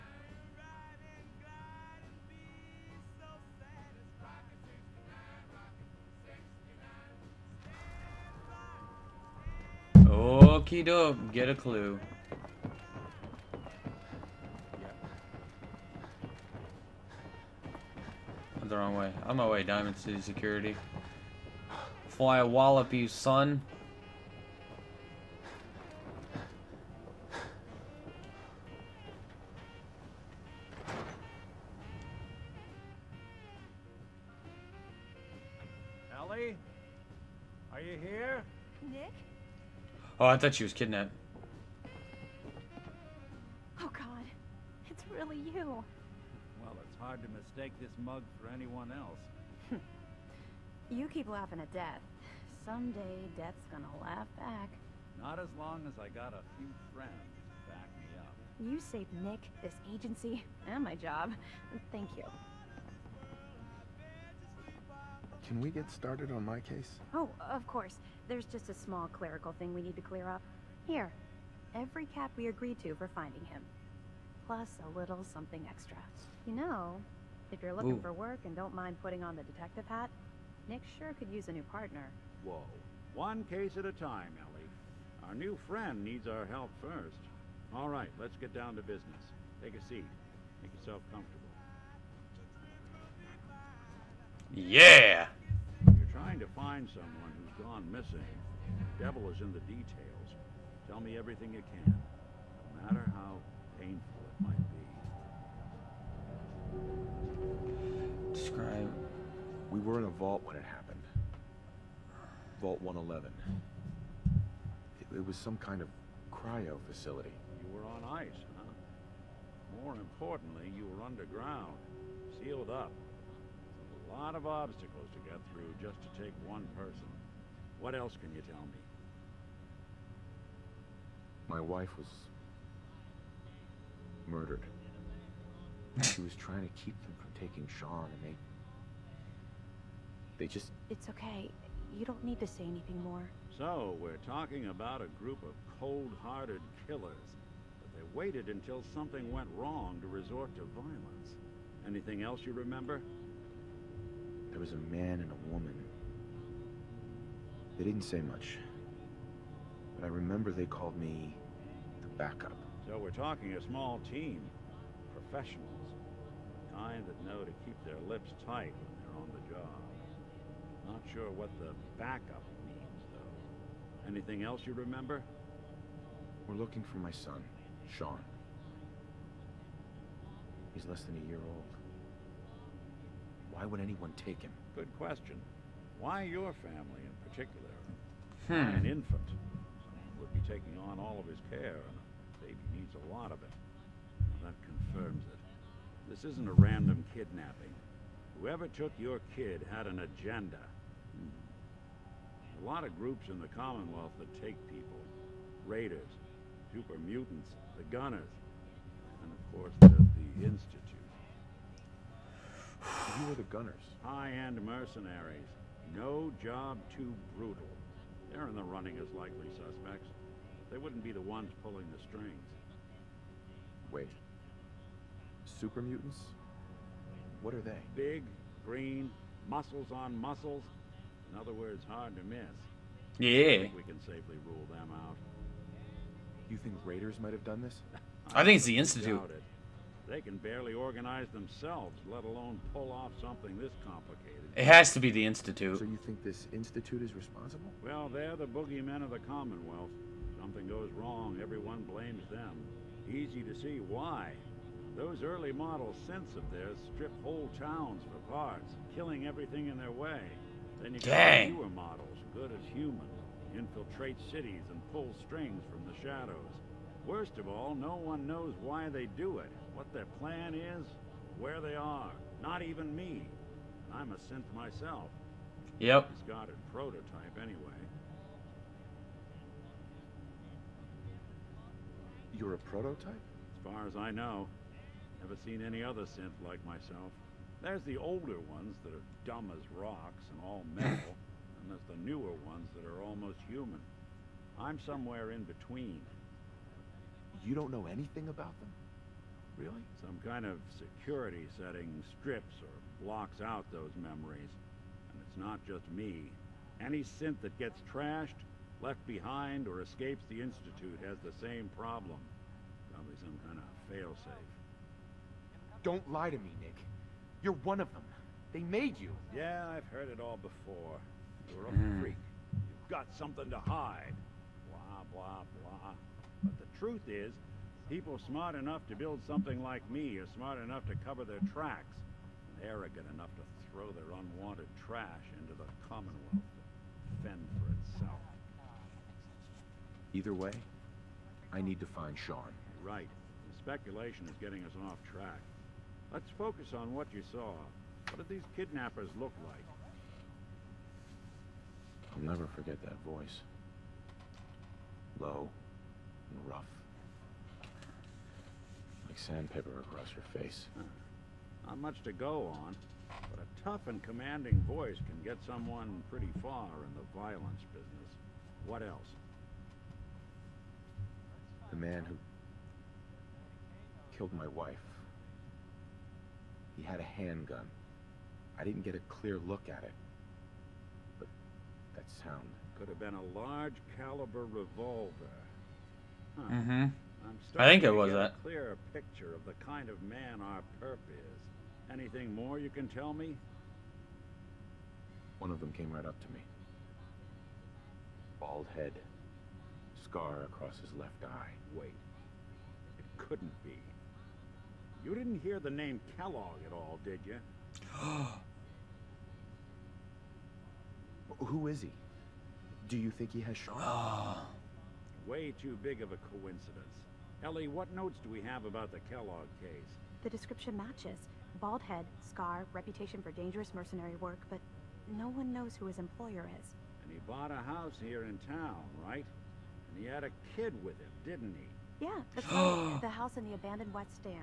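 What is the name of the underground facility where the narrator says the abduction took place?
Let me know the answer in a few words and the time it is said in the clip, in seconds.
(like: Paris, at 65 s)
Vault 111, at 112 s.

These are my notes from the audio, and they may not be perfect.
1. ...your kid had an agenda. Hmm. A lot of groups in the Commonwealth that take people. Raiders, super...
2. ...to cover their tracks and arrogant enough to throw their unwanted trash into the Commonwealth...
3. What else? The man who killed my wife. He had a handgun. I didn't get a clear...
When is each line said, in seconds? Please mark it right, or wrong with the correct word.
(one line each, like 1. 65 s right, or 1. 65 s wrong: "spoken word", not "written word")
1. 198 s right
2. 330 s right
3. 368 s right.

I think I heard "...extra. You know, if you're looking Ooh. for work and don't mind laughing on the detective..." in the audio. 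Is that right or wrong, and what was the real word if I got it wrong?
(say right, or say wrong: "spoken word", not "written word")
wrong: "putting", not "laughing".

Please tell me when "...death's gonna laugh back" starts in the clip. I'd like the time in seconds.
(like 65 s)
53 s.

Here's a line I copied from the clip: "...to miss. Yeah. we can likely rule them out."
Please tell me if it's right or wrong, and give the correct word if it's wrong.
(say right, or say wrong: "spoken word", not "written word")
wrong: "safely", not "likely".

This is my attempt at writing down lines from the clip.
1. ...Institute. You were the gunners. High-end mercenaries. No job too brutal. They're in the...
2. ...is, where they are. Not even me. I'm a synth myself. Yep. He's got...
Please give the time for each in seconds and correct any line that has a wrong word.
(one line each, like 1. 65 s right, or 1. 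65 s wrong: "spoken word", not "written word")
1. 210 s right
2. 270 s right.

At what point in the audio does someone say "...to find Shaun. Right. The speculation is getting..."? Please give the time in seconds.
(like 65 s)
341 s.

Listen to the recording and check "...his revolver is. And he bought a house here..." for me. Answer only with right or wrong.
wrong.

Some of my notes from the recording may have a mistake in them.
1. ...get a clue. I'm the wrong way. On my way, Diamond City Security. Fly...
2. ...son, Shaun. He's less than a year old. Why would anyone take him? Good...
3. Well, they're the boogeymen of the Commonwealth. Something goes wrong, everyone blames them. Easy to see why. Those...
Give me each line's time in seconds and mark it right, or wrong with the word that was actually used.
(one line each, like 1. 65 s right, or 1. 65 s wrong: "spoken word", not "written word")
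1. 11 s right
2. 177 s right
3. 247 s right.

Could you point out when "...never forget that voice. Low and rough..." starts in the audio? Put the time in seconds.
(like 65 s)
352 s.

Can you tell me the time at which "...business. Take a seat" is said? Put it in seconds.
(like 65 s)
88 s.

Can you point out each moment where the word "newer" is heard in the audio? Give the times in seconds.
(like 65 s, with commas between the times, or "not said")
261 s, 292 s.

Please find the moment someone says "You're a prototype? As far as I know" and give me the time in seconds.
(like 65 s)
282 s.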